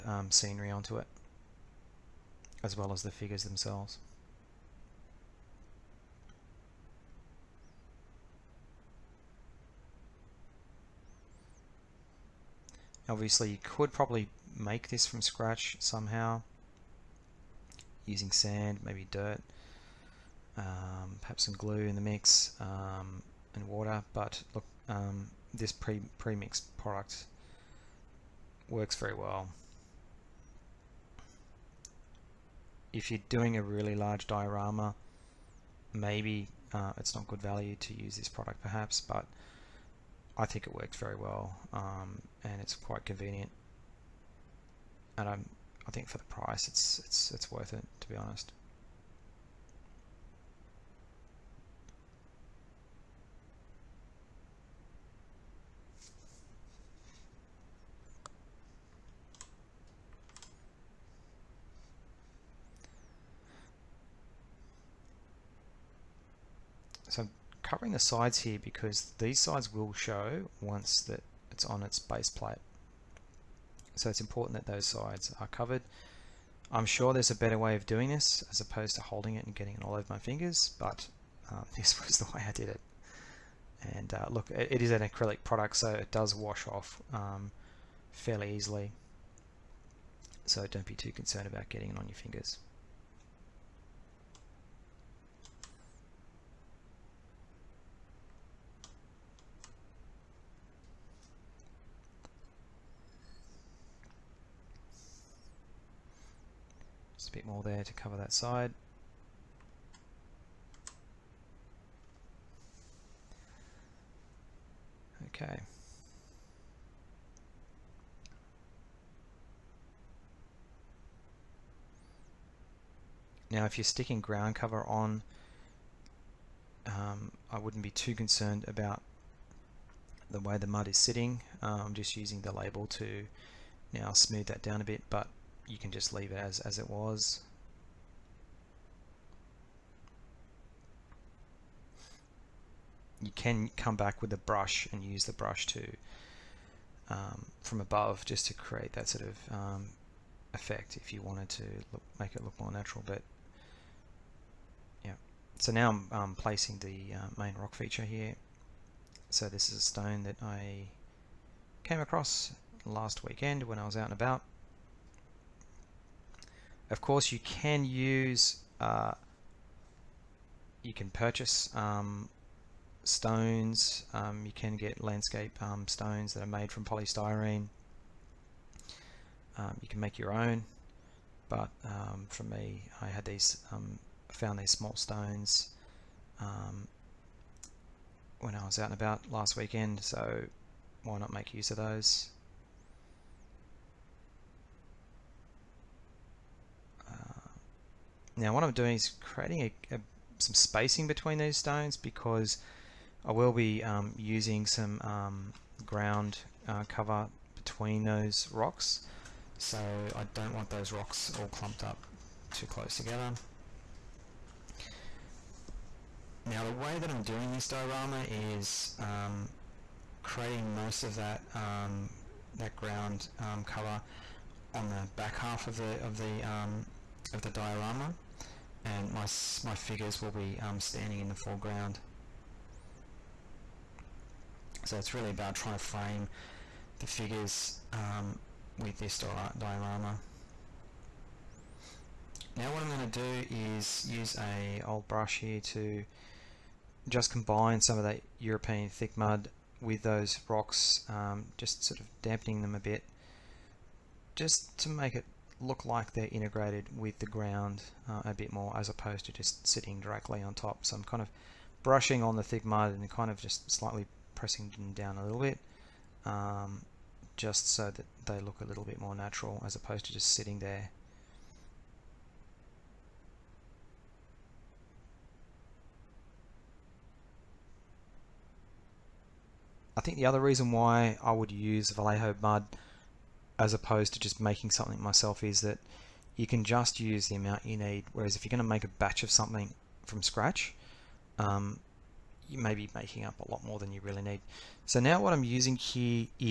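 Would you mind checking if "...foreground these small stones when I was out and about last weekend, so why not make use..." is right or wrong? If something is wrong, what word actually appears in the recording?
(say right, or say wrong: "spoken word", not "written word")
wrong: "found", not "foreground".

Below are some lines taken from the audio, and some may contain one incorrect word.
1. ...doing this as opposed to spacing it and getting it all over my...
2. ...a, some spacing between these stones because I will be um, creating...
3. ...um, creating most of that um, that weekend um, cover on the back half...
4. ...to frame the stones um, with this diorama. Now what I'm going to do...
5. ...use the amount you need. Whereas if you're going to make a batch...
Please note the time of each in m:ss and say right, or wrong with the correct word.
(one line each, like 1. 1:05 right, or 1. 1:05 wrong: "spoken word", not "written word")
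1. 1:17 wrong: "holding", not "spacing"
2. 3:19 wrong: "using", not "creating"
3. 3:38 wrong: "ground", not "weekend"
4. 3:55 wrong: "figures", not "stones"
5. 4:46 right.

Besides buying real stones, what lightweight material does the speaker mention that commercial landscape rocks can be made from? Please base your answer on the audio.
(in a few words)
Polystyrene.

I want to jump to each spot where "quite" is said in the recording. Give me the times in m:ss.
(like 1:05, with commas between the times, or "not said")
0:42.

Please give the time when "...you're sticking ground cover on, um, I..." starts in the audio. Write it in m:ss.
2:03.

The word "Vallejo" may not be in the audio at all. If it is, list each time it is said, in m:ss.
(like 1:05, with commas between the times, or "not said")
4:41.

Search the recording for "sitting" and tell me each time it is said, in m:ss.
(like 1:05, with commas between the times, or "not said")
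2:10, 4:19, 4:30.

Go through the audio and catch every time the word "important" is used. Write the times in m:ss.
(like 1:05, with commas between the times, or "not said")
1:14.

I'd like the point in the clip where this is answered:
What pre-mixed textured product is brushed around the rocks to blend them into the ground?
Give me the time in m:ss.
4:08.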